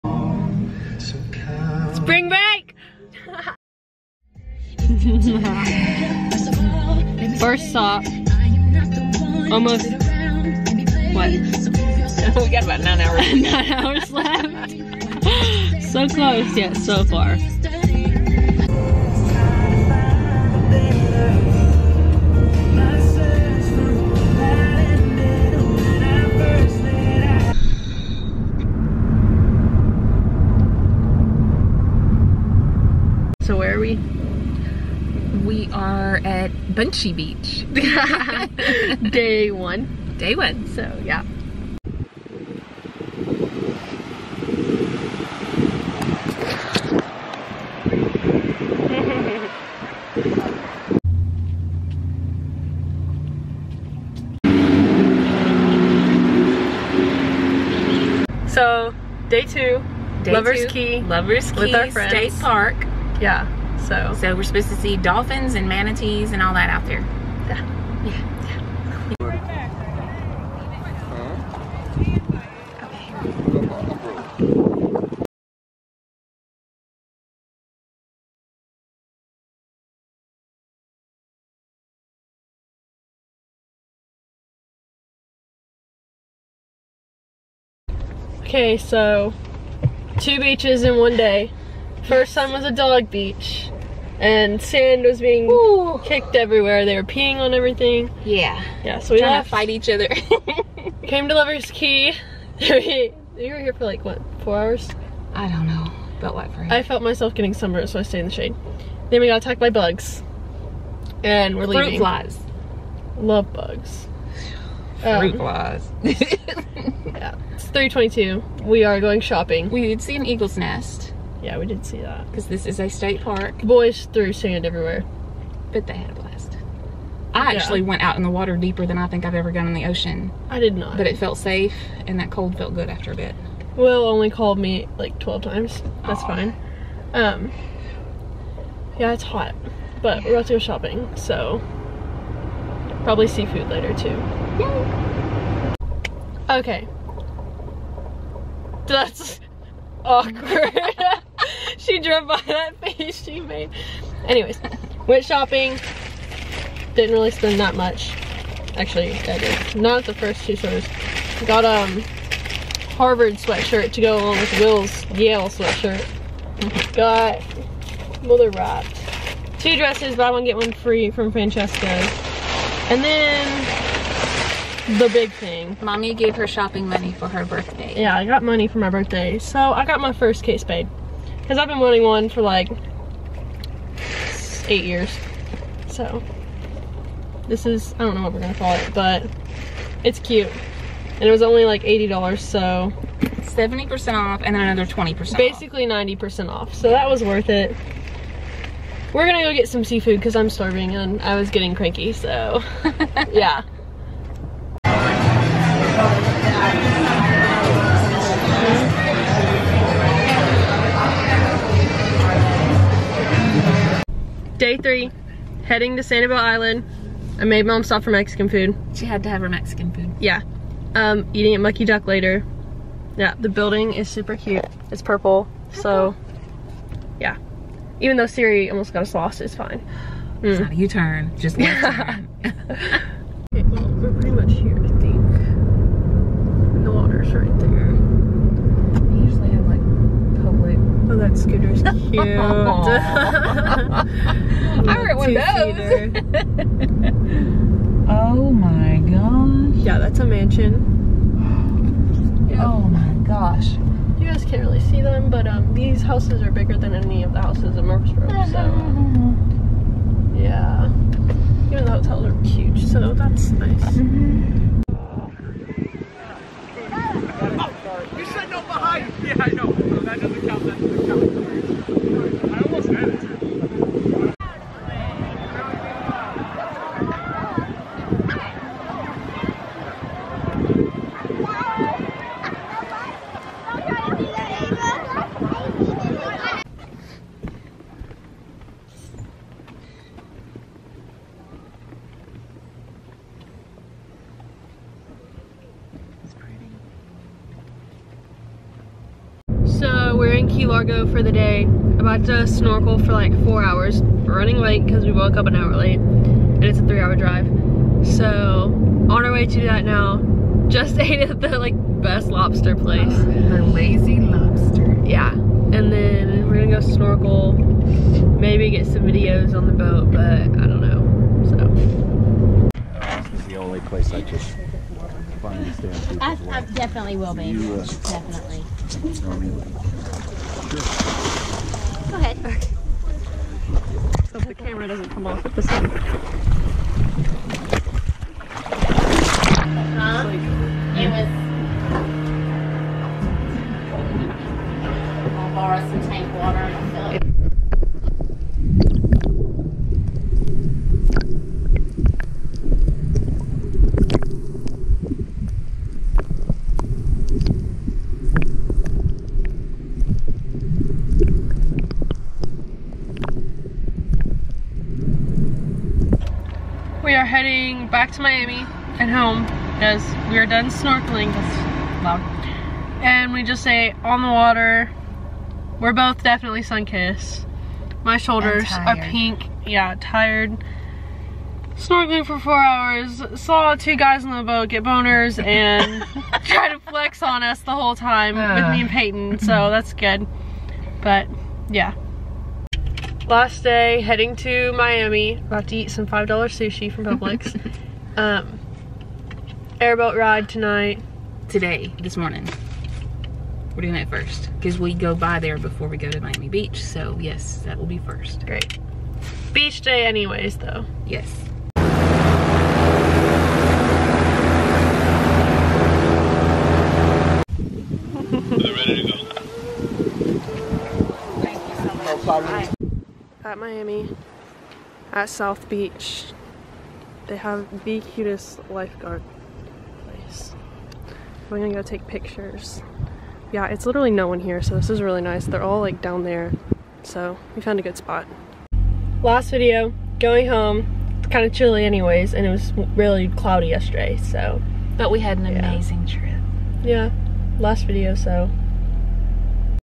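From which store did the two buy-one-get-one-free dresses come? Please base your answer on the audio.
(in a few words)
Francesca.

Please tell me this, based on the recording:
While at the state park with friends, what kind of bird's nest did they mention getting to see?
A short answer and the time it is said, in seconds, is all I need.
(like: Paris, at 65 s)
an eagle's nest, at 120 s.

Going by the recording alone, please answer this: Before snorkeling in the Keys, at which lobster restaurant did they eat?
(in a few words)
The Lazy Lobster.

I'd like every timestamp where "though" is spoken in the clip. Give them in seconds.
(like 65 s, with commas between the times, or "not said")
228 s, 410 s.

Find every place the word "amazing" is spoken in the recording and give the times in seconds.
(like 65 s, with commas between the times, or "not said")
445 s.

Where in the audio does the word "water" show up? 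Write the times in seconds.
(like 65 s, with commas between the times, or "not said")
128 s, 236 s, 374 s.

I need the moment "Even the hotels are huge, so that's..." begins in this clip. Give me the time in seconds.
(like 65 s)
261 s.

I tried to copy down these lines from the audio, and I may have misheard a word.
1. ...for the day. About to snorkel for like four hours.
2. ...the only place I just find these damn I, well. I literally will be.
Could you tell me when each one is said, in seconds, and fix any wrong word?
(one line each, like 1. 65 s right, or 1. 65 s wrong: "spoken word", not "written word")
1. 301 s right
2. 323 s wrong: "definitely", not "literally".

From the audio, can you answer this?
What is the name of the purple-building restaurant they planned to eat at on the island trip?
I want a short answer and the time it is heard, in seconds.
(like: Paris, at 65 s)
Mucky Duck, at 221 s.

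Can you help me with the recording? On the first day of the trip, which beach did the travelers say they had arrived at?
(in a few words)
Bunchy Beach.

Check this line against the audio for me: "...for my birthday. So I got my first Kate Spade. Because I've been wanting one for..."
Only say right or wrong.
right.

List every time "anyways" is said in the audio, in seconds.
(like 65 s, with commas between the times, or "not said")
154 s, 410 s, 441 s.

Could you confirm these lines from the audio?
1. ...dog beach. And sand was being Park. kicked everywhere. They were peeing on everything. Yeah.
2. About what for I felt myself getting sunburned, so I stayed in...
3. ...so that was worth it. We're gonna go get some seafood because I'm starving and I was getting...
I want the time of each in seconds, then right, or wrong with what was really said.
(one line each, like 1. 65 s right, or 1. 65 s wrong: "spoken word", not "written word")
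1. 92 s wrong: "Ooh", not "Park"
2. 106 s right
3. 196 s right.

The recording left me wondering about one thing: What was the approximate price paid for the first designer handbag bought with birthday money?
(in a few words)
$80.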